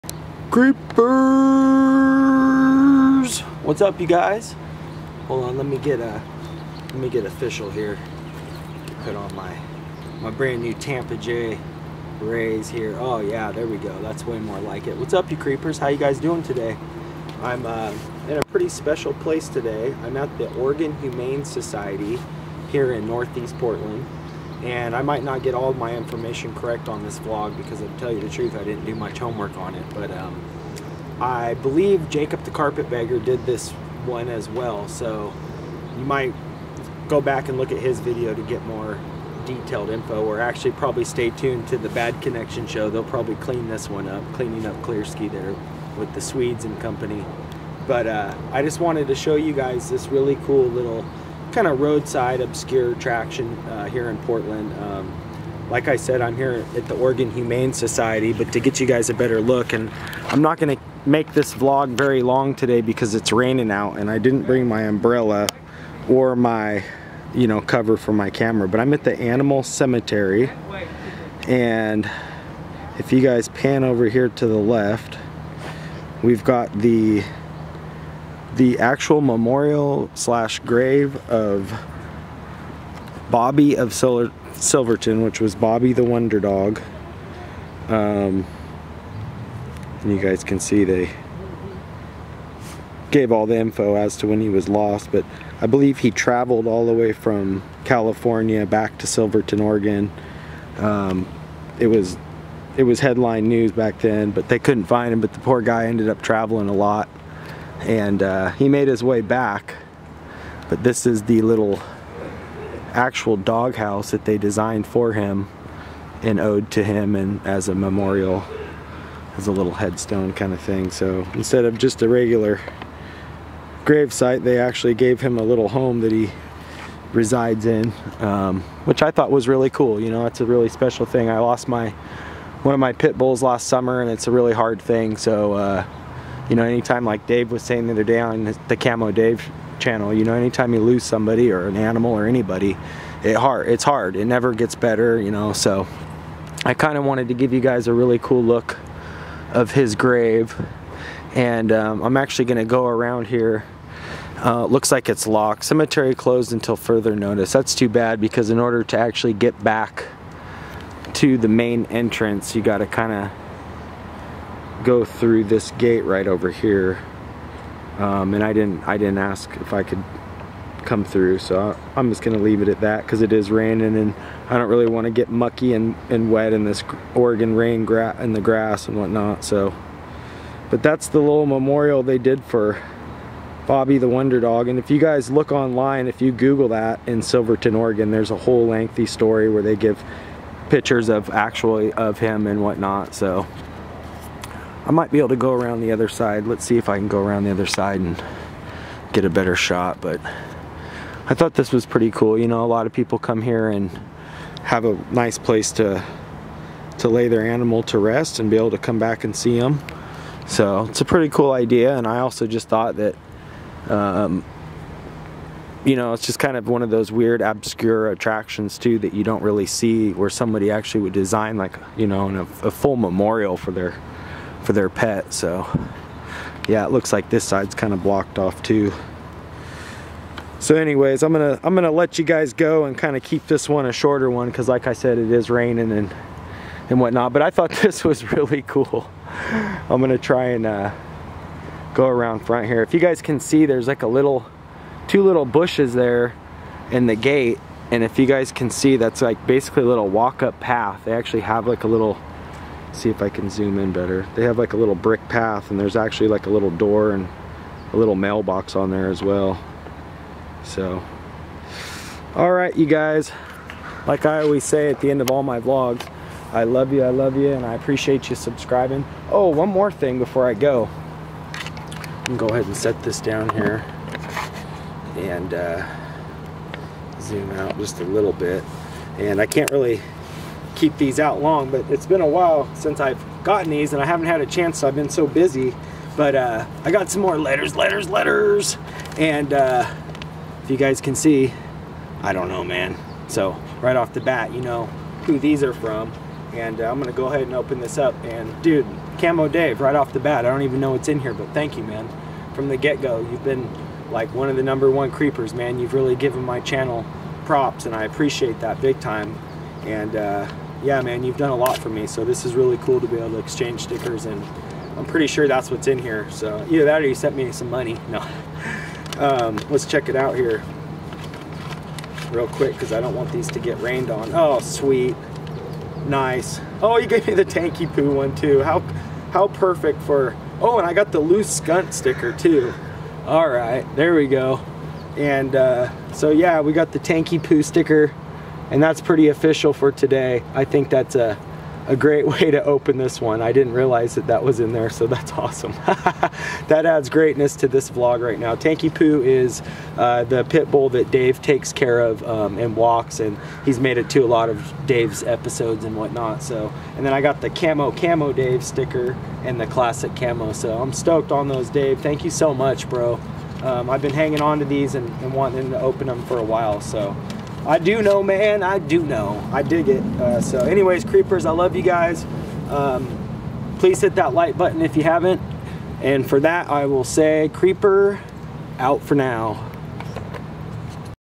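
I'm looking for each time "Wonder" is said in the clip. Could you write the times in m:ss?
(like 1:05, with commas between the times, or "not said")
1:26, 3:04.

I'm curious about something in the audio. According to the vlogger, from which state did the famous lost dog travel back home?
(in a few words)
California.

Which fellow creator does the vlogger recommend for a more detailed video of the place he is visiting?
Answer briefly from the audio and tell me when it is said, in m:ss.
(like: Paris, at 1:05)
Jacob the Carpetbagger, at 0:32.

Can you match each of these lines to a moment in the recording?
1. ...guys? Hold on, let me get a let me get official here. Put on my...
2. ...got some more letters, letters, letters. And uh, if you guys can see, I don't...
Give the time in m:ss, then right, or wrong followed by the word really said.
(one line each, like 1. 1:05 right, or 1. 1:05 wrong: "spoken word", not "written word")
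1. 0:04 right
2. 4:46 right.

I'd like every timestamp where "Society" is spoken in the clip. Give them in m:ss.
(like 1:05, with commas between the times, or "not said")
0:21, 0:57.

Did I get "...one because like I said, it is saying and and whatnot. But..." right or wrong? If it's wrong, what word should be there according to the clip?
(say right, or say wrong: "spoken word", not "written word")
wrong: "raining", not "saying".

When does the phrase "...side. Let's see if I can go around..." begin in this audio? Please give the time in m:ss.
3:16.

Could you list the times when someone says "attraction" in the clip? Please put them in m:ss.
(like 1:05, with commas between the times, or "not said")
0:52, 3:38.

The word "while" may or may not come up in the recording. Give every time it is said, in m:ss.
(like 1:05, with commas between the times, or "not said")
4:42, 6:06.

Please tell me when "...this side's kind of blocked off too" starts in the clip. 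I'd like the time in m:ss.
3:47.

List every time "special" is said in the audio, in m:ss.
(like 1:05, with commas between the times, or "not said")
0:18, 2:10.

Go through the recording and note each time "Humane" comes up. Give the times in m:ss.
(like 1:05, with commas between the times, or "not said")
0:20, 0:57.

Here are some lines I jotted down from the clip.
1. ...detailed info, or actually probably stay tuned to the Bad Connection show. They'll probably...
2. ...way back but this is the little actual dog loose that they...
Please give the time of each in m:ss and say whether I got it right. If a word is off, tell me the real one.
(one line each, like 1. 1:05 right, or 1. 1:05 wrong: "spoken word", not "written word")
1. 0:39 right
2. 1:49 wrong: "house", not "loose".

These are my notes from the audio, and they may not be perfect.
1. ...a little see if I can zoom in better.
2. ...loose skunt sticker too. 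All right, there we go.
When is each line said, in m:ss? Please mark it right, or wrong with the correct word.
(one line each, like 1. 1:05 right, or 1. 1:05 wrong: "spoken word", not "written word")
1. 4:11 right
2. 5:31 right.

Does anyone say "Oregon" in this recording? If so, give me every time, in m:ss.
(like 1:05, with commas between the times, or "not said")
0:20, 0:56, 1:39, 2:57, 3:07.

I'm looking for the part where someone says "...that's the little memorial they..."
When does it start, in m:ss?
3:00.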